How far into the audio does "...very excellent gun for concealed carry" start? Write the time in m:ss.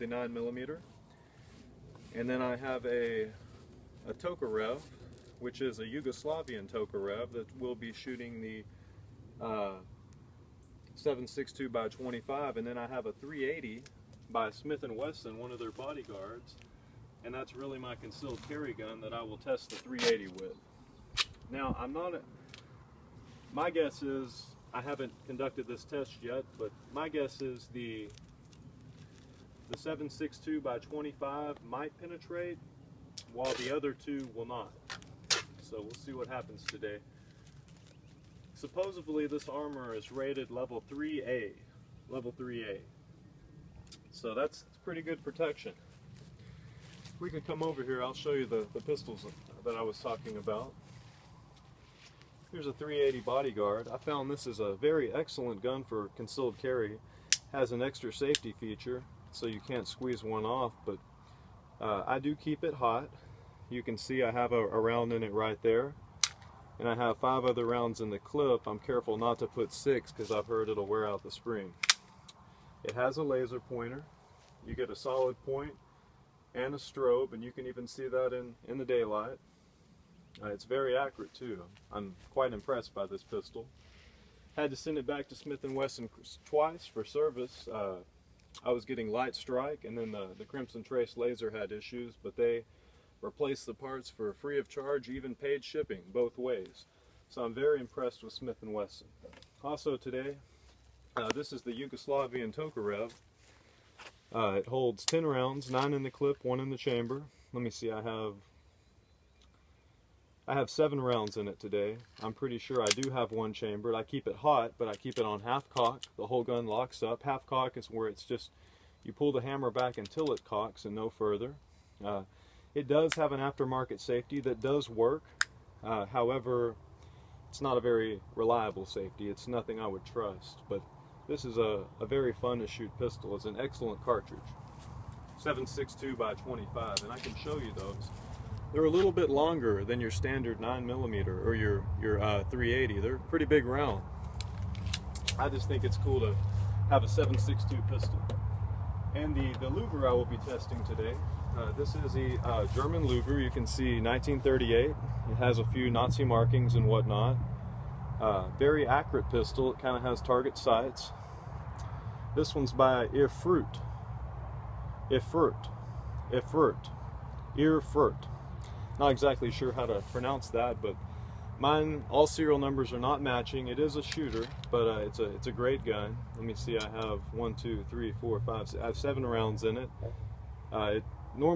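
0:54.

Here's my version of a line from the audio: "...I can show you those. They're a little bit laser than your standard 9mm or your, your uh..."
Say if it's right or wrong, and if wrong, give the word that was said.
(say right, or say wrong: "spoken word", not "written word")
wrong: "longer", not "laser".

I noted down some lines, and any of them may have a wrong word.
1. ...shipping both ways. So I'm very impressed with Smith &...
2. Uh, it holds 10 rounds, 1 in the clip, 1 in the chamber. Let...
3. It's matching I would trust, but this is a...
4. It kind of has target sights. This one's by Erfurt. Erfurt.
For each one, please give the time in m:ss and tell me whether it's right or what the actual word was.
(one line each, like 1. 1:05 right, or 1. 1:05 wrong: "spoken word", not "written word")
1. 1:35 right
2. 1:44 wrong: "9", not "1"
3. 2:09 wrong: "nothing", not "matching"
4. 2:39 right.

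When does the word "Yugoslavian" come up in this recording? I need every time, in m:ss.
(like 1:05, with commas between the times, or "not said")
0:05, 1:41.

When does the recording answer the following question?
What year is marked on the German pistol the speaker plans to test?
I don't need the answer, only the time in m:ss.
2:33.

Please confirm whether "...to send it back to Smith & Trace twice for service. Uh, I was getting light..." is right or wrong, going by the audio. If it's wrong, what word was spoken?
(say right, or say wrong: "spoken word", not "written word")
wrong: "Wesson", not "Trace".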